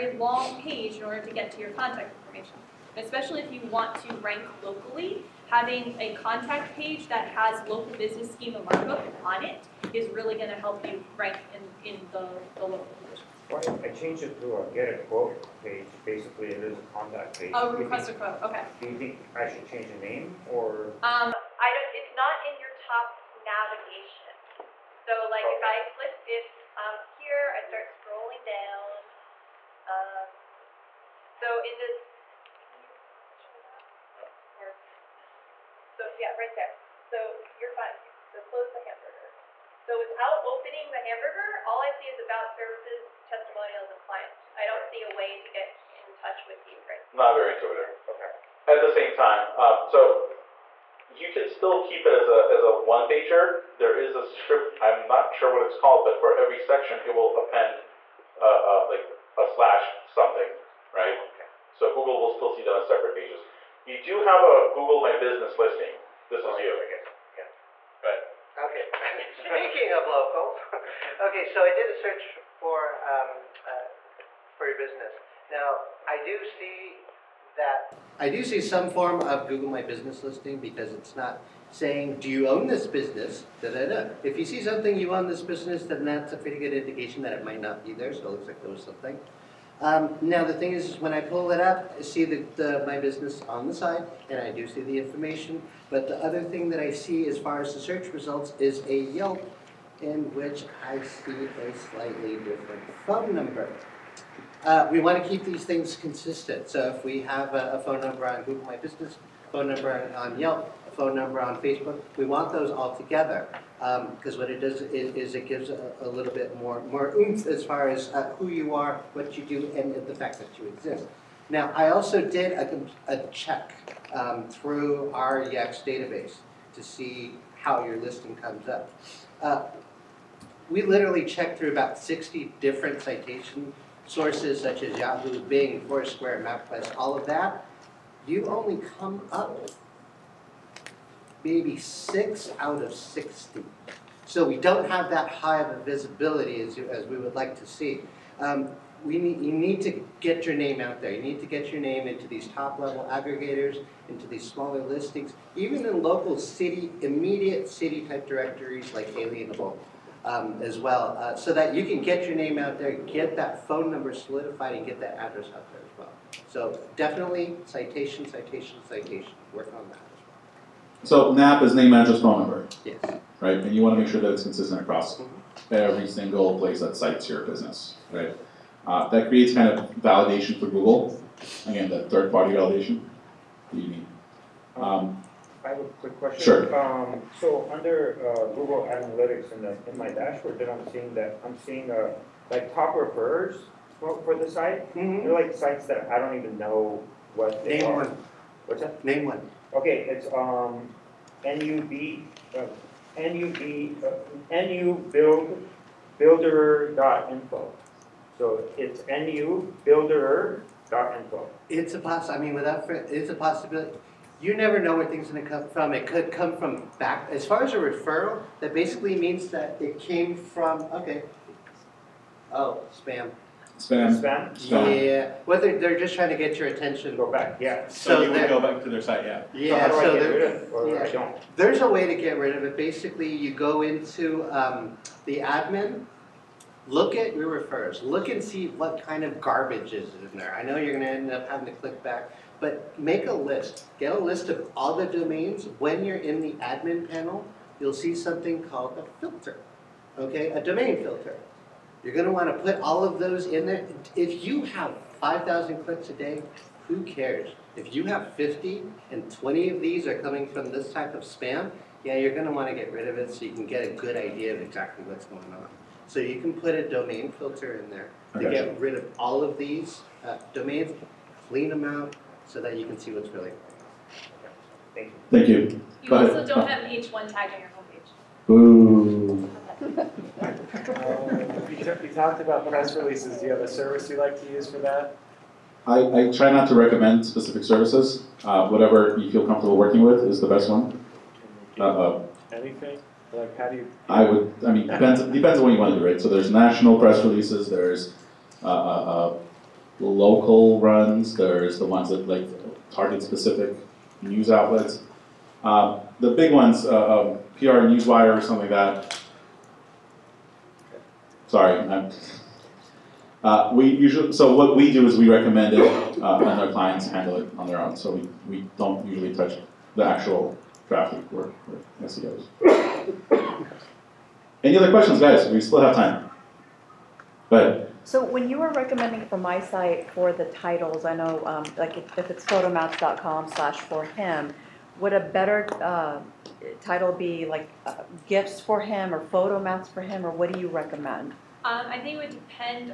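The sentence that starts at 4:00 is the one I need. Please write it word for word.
I know you're going to end up having to click back but make a list.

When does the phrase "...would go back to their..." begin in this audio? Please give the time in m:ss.
3:48.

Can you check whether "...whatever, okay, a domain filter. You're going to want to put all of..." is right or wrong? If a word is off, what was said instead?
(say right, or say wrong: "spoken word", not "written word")
wrong: "filter", not "whatever".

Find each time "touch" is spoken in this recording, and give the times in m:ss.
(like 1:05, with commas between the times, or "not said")
0:46, 5:19.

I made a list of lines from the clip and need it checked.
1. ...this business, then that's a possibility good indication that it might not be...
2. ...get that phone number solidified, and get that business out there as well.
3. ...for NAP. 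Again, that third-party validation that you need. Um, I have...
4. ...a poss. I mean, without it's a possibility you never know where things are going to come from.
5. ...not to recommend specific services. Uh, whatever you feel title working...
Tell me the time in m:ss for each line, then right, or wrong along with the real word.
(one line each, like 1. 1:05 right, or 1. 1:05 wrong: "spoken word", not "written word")
1. 1:25 wrong: "pretty", not "possibility"
2. 2:42 wrong: "address", not "business"
3. 3:00 wrong: "Google", not "NAP"
4. 3:31 right
5. 4:46 wrong: "comfortable", not "title".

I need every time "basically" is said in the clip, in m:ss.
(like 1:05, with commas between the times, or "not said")
0:16, 3:38, 3:52.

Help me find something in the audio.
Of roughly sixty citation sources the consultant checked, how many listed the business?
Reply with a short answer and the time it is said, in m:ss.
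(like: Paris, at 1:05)
6, at 2:21.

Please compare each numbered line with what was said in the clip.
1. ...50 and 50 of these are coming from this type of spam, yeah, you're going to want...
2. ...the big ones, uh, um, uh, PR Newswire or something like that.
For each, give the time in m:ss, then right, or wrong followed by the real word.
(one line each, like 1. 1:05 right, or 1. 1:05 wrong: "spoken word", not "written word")
1. 4:18 wrong: "20", not "50"
2. 5:06 right.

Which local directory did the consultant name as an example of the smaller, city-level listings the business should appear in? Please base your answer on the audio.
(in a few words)
Alignable.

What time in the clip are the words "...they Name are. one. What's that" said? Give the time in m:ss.
3:17.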